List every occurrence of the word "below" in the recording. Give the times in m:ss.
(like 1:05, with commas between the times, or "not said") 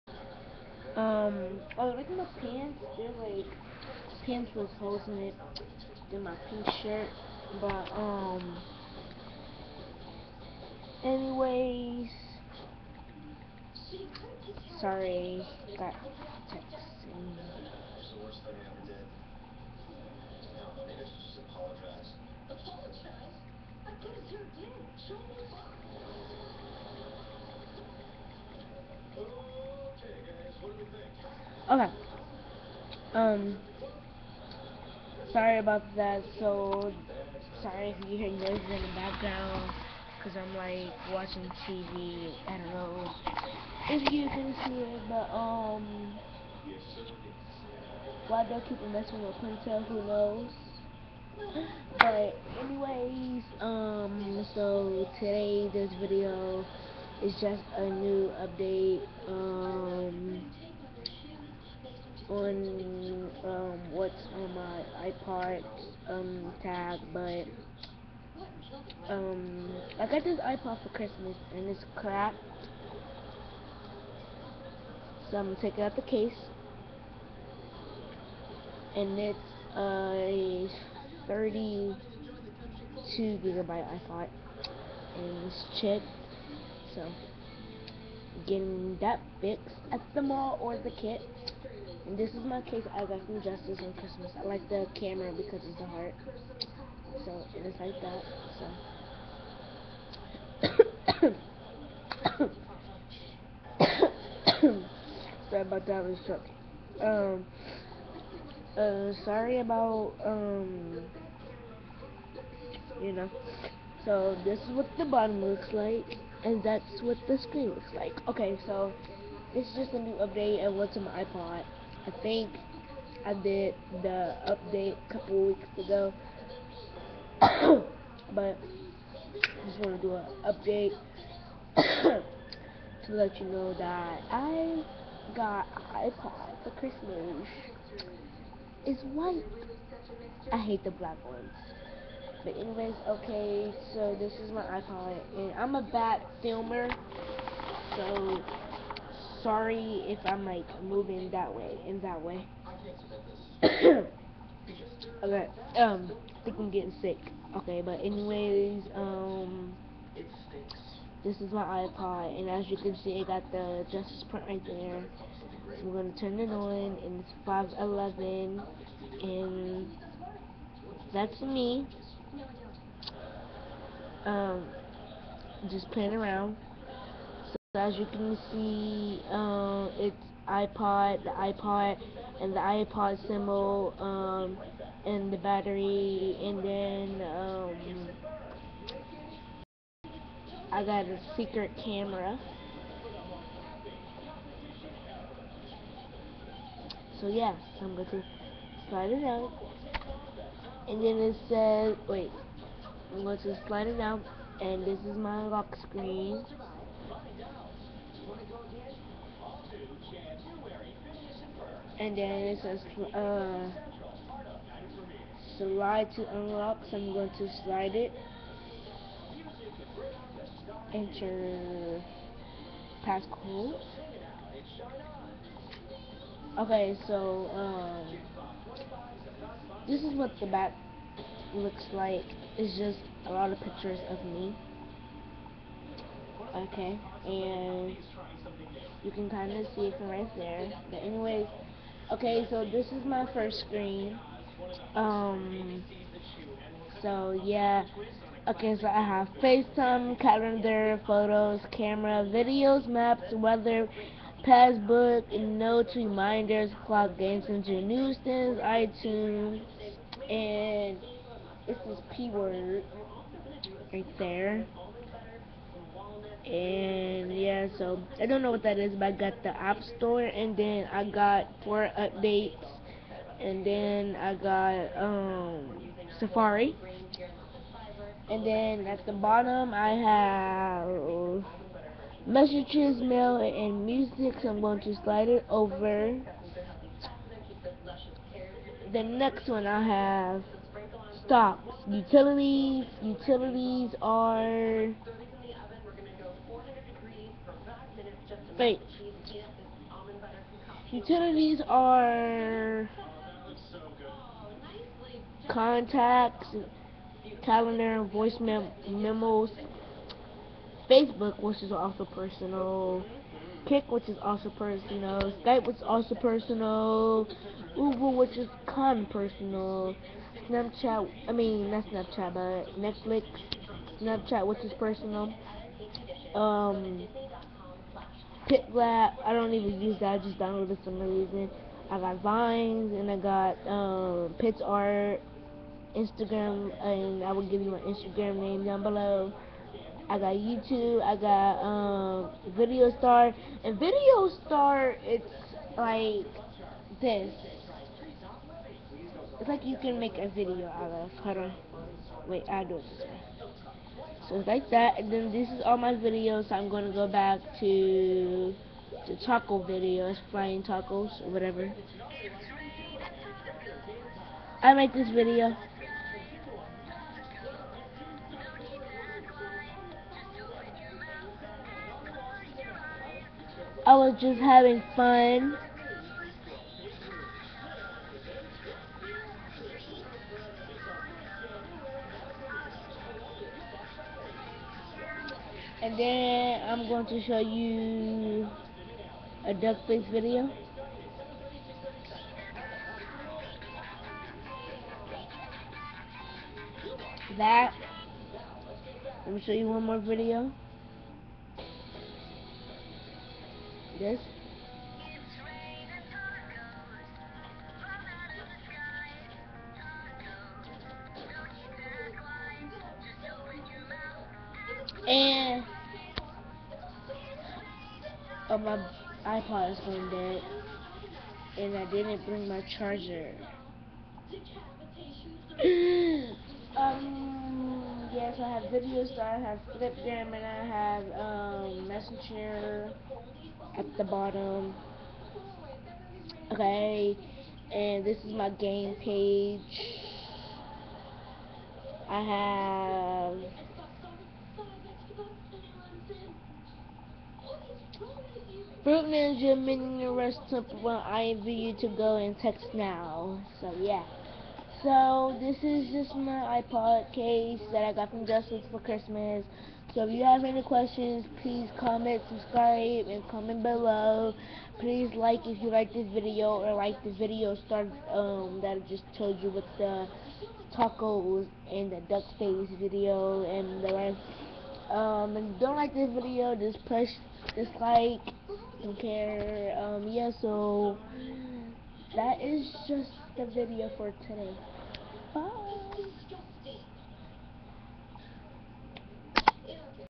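5:38, 7:43.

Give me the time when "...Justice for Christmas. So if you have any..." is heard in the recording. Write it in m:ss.
7:38.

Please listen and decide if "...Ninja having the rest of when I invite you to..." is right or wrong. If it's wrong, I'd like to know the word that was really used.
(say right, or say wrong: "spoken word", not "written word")
wrong: "meaning", not "having".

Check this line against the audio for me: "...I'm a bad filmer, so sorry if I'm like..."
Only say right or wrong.
right.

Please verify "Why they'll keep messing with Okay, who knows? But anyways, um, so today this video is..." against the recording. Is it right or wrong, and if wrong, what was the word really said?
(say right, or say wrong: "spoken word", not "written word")
wrong: "Quintel", not "Okay".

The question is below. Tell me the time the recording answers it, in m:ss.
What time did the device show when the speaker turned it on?
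2:47.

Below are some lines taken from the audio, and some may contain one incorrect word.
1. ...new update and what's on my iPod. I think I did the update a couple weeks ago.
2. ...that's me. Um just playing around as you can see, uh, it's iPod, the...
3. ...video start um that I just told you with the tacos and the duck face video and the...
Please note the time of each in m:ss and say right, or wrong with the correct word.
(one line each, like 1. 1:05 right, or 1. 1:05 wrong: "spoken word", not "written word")
1. 1:59 right
2. 2:51 right
3. 7:47 right.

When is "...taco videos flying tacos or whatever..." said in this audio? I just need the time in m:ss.
5:59.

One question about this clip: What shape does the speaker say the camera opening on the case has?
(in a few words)
heart.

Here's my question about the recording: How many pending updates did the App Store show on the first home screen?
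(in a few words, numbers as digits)
4.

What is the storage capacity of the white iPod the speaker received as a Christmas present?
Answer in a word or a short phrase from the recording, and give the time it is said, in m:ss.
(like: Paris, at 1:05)
32 gigabytes, at 1:21.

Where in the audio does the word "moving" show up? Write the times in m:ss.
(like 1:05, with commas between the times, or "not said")
2:30.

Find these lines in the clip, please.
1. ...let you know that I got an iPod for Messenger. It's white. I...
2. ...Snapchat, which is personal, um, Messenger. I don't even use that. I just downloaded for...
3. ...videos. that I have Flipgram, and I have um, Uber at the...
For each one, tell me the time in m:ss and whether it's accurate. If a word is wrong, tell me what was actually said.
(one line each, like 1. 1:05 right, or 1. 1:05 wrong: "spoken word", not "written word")
1. 2:13 wrong: "Christmas", not "Messenger"
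2. 5:23 wrong: "PicLab", not "Messenger"
3. 7:08 wrong: "Messenger", not "Uber".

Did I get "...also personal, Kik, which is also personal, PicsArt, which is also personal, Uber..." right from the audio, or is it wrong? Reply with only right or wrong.
wrong.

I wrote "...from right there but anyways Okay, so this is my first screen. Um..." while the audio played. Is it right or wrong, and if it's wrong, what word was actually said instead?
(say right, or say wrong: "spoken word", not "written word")
right.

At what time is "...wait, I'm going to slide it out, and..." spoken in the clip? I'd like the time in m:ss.
3:22.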